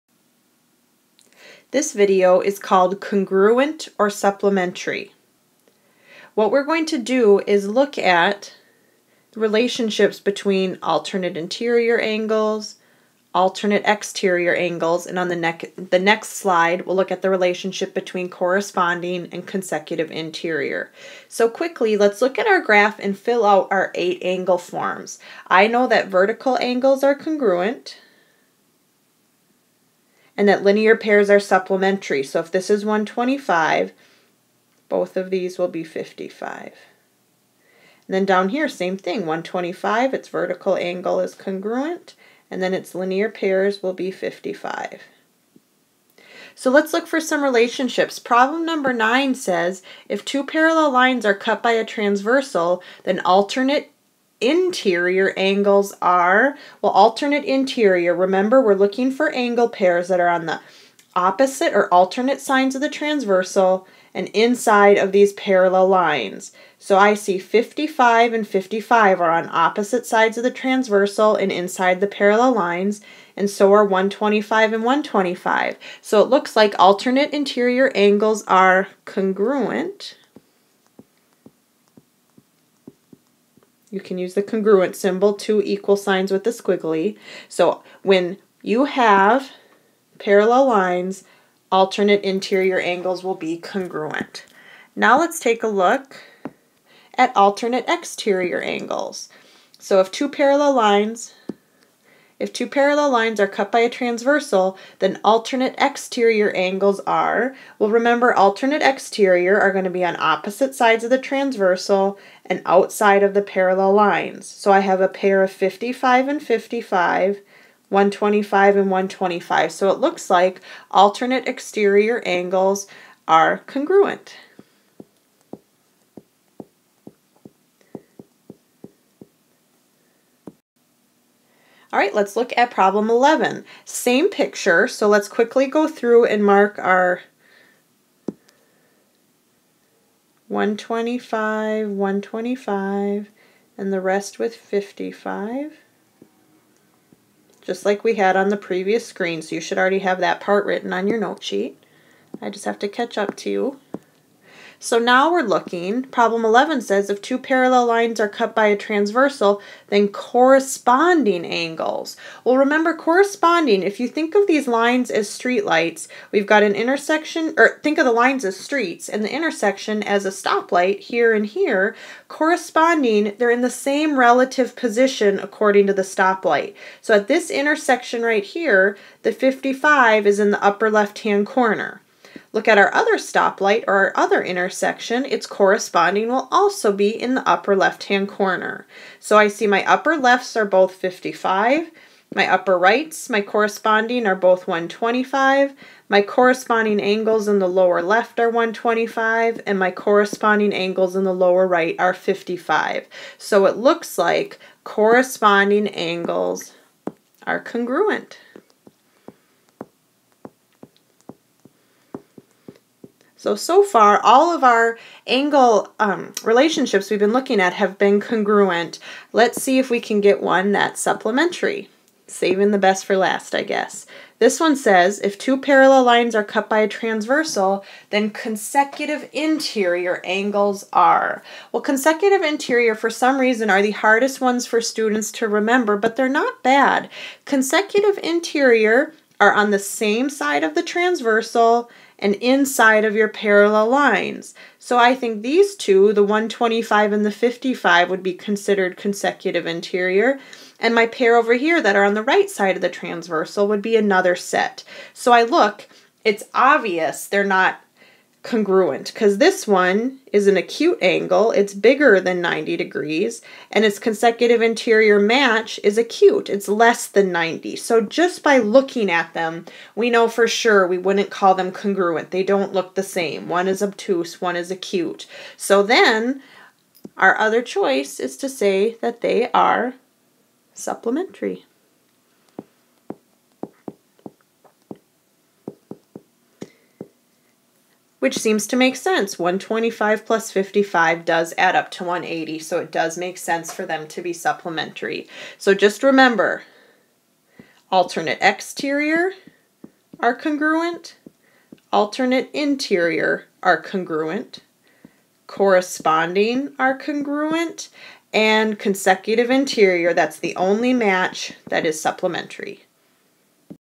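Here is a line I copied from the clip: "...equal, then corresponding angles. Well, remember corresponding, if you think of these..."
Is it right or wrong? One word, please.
wrong.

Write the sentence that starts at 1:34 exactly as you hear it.
Now let's take a look at alternate exterior angles.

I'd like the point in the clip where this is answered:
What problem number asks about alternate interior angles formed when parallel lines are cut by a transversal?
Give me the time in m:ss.
0:48.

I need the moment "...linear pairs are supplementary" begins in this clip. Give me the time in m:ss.
0:30.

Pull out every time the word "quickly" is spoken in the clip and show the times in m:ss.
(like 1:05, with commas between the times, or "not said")
0:21, 2:15.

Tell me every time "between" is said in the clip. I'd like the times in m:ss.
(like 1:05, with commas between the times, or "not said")
0:10, 0:17.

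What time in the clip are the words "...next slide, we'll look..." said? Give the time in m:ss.
0:15.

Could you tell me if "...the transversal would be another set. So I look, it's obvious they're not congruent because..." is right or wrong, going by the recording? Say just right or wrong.
right.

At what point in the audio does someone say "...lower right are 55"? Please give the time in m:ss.
3:21.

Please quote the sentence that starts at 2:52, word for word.
Corresponding, they're in the same relative position according to the stoplight.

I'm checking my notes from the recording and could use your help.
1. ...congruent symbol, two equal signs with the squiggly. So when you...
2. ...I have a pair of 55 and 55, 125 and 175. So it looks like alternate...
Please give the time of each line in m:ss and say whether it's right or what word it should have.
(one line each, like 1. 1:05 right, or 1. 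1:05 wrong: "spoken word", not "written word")
1. 1:24 right
2. 1:54 wrong: "125", not "175".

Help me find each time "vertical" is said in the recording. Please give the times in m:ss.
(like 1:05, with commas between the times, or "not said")
0:26, 0:40.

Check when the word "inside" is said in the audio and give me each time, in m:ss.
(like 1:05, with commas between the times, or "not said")
1:04, 1:11, 4:02.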